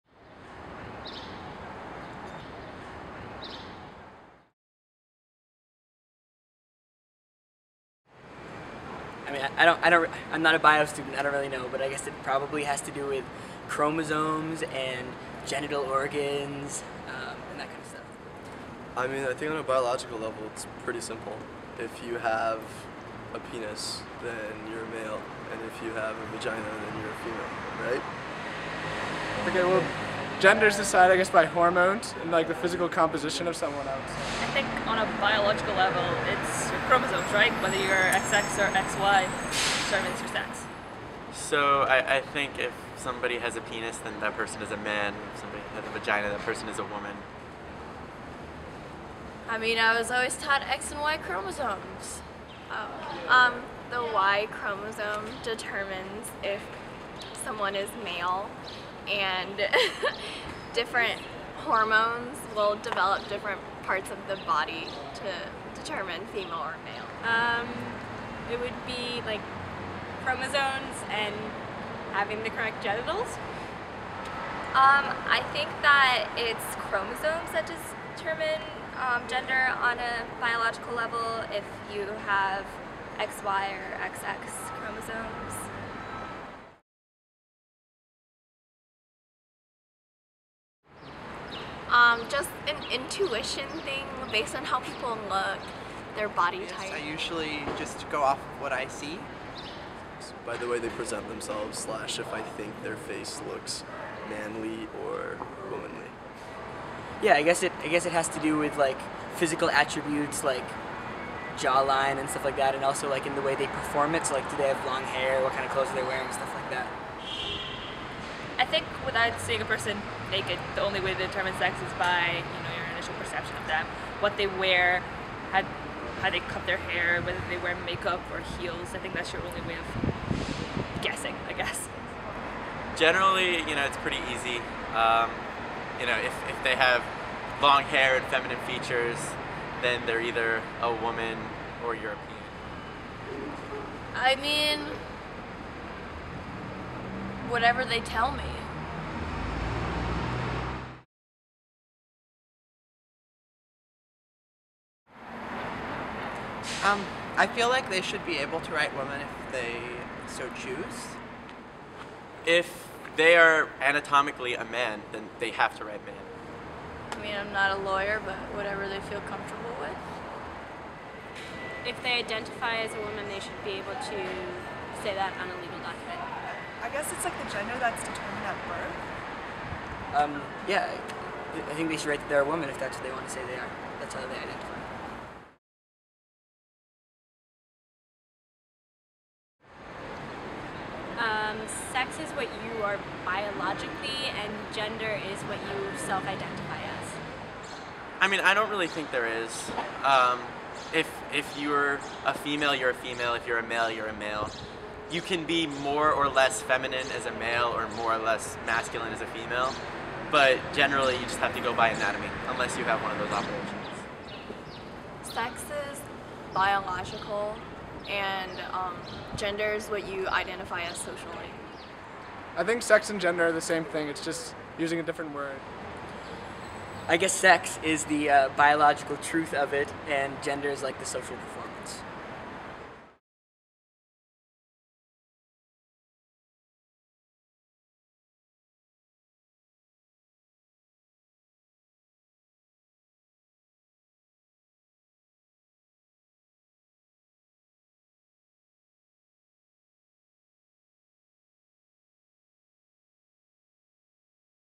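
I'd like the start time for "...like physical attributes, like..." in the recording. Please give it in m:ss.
1:48.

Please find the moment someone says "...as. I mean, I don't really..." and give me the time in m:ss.
3:16.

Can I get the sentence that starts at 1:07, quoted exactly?
Um, it would be like chromosomes and having the correct genitals.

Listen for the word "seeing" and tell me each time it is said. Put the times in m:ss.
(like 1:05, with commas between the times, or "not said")
1:59.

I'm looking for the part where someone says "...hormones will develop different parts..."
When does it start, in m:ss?
1:01.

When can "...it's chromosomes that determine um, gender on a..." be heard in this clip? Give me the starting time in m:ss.
1:16.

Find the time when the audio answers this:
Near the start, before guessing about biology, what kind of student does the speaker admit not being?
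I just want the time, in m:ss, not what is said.
0:10.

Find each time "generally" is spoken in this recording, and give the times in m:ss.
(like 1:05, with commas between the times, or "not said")
2:12, 3:30.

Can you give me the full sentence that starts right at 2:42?
If they are anatomically a man, then they have to write man.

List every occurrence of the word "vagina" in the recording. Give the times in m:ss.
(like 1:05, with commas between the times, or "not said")
0:26, 0:45.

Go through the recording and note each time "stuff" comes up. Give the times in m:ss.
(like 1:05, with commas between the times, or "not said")
0:17, 1:52, 1:56.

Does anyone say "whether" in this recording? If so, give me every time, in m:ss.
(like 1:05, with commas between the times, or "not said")
0:37, 2:07.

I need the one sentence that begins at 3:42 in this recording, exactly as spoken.
I think sex and gender are the same thing, it's just using a different word.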